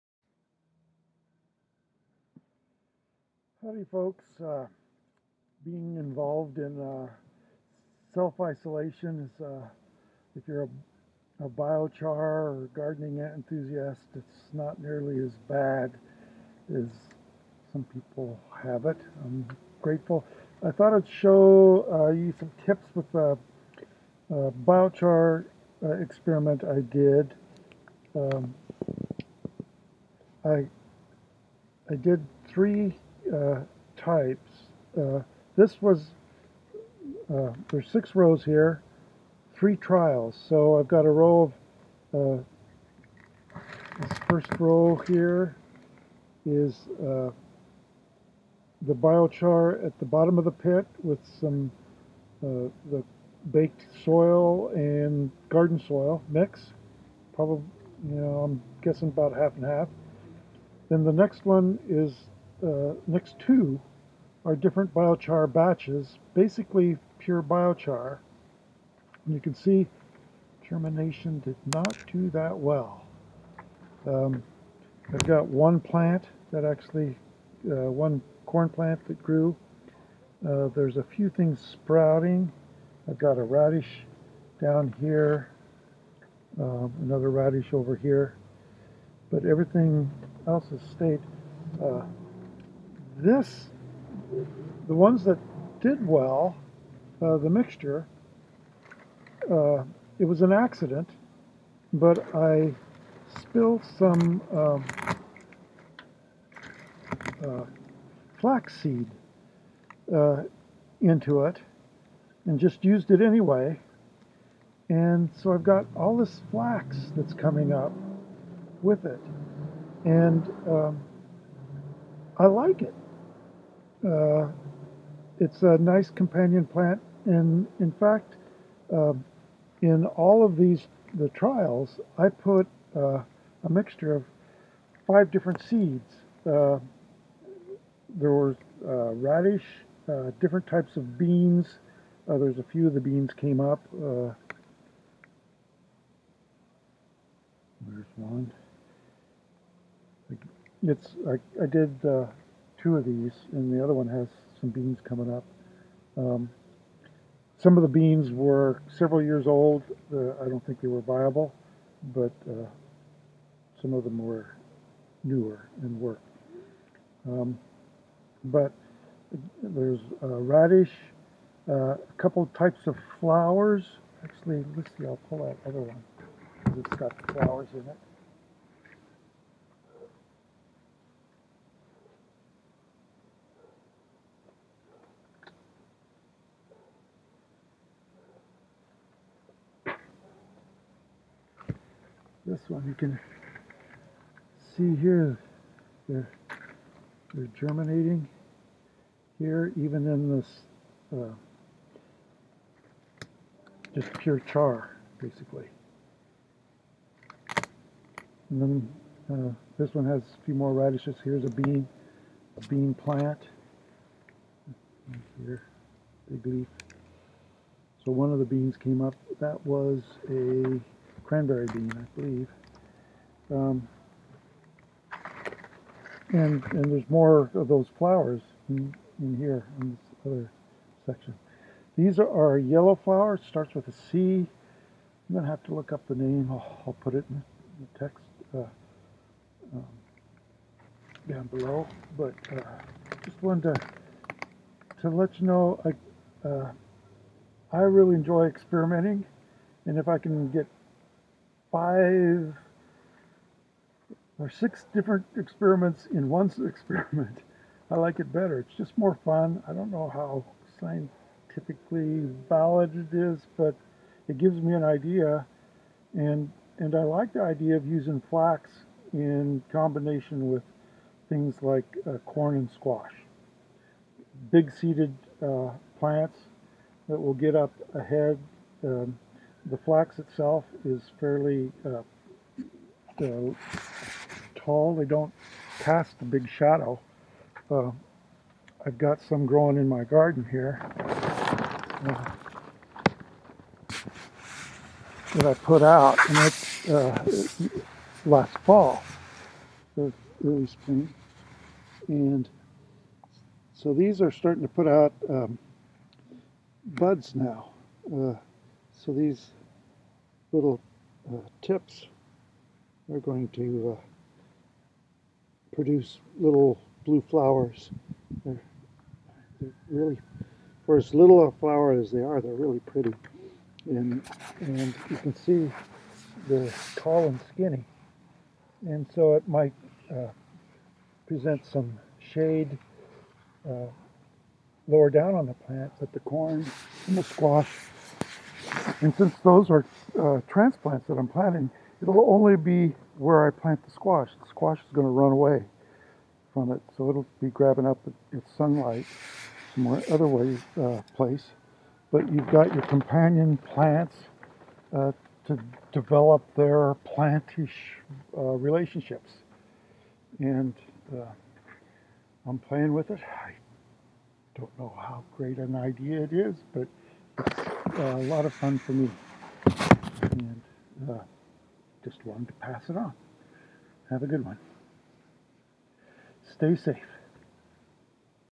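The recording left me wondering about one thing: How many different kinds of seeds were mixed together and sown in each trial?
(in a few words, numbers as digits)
5.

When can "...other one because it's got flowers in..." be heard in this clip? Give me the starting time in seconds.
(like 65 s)
175 s.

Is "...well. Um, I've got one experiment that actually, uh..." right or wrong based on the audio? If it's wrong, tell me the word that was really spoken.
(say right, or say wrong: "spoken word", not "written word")
wrong: "plant", not "experiment".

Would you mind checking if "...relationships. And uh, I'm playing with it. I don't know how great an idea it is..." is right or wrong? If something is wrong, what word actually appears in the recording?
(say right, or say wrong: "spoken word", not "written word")
right.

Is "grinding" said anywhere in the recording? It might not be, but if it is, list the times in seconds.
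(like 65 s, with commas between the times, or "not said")
not said.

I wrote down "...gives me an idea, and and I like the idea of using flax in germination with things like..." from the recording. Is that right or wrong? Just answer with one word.
wrong.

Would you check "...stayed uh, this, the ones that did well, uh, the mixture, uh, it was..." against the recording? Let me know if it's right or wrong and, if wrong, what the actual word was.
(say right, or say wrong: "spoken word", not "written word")
right.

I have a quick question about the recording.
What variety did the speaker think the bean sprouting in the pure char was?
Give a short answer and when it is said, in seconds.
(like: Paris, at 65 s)
Cranberry bean, at 221 s.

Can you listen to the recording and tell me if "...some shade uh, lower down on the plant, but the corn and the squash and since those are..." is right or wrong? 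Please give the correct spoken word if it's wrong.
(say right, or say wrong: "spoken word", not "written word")
right.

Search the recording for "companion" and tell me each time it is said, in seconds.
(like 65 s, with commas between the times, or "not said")
126 s, 352 s.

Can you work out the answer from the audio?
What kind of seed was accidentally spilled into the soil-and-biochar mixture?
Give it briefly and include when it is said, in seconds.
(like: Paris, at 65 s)
Flaxseed, at 108 s.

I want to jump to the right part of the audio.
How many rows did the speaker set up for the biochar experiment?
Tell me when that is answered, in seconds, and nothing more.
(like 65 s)
37 s.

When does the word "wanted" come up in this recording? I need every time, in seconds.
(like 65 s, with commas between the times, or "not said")
243 s, 372 s.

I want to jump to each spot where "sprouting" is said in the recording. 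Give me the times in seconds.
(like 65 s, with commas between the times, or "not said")
81 s.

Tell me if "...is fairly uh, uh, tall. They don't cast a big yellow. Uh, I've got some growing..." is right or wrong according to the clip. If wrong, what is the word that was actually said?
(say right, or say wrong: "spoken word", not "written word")
wrong: "shadow", not "yellow".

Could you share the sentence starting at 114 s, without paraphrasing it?
And so I've got all this flax that's coming up with it.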